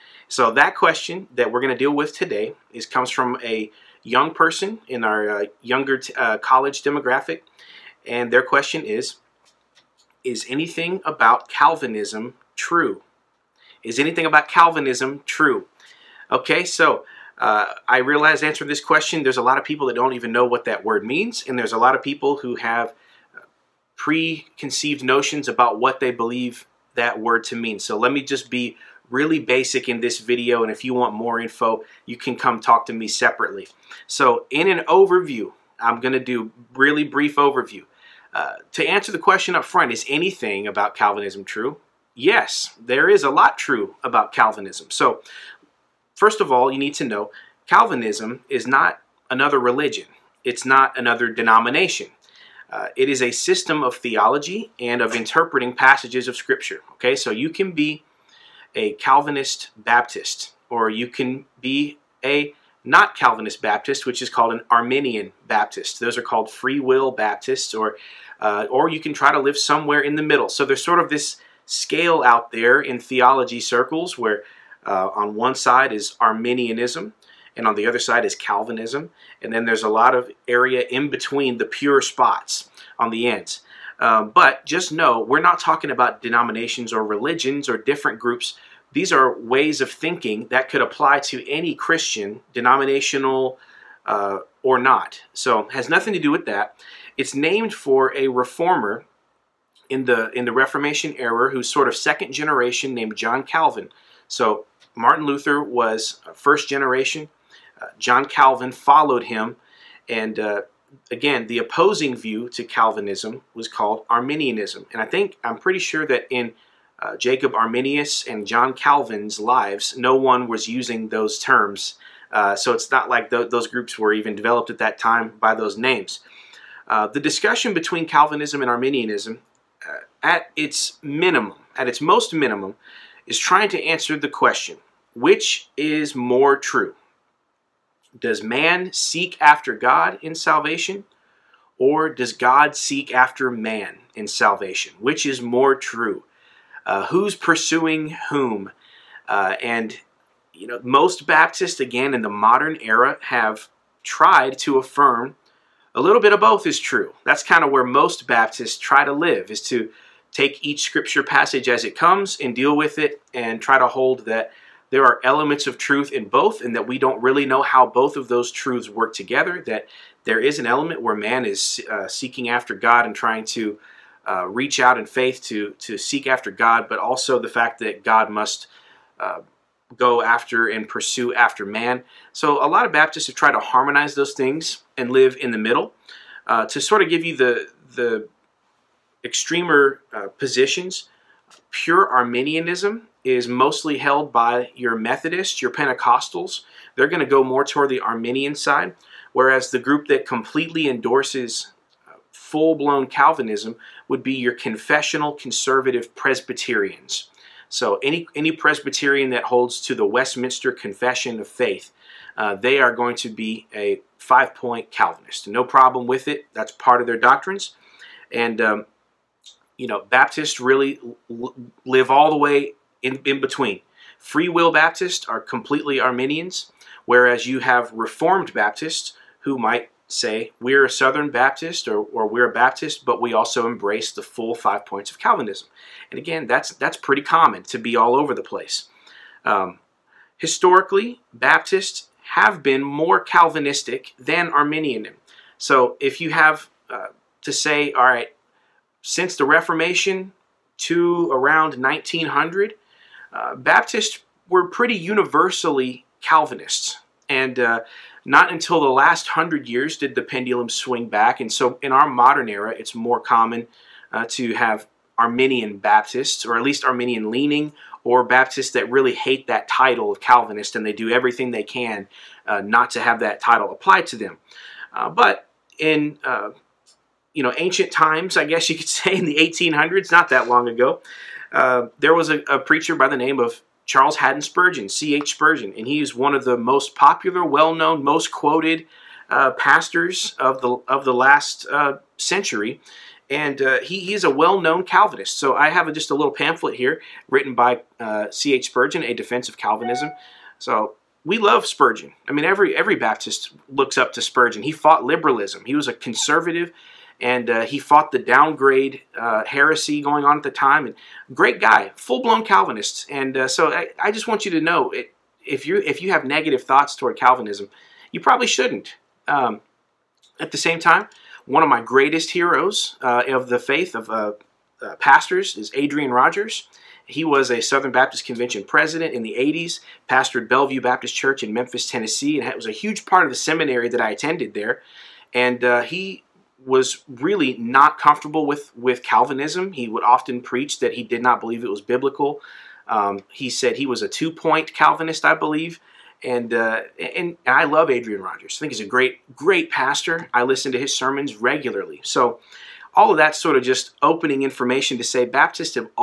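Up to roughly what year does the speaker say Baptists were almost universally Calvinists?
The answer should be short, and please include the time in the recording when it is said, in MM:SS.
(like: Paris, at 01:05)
1900, at 04:11.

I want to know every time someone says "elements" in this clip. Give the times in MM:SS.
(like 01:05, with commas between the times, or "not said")
02:45, 02:50.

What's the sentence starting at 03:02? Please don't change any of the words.
So a lot of Baptists have tried to harmonize those things and live in the middle.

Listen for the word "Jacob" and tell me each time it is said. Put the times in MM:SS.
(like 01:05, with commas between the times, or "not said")
01:57.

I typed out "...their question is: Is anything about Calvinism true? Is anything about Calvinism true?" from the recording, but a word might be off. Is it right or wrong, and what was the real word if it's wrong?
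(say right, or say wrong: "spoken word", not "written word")
right.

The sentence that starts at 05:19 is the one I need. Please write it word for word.
Um, at the same time, one of my greatest heroes uh, of the faith of uh, uh, pastors is Adrian Rogers.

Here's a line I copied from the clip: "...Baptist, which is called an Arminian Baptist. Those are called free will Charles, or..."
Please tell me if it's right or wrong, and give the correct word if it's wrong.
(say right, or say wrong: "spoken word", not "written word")
wrong: "Baptists", not "Charles".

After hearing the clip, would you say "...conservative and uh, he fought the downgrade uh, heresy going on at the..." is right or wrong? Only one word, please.
right.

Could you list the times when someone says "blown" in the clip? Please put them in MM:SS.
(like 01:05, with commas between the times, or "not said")
03:22, 05:12.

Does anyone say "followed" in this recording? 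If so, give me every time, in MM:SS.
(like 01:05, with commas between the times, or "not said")
01:48.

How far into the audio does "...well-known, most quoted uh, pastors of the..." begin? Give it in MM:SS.
04:47.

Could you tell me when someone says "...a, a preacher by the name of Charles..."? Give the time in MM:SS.
04:42.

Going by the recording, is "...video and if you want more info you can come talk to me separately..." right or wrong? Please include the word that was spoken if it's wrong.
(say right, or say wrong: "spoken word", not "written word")
right.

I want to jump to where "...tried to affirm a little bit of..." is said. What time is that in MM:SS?
02:34.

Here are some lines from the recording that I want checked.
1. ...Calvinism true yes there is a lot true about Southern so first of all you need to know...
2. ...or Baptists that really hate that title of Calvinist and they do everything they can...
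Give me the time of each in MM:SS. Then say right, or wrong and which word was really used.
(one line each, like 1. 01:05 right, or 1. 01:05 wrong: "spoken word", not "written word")
1. 00:40 wrong: "Calvinism", not "Southern"
2. 04:28 right.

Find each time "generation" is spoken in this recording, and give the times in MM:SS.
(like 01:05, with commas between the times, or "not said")
01:42, 01:46.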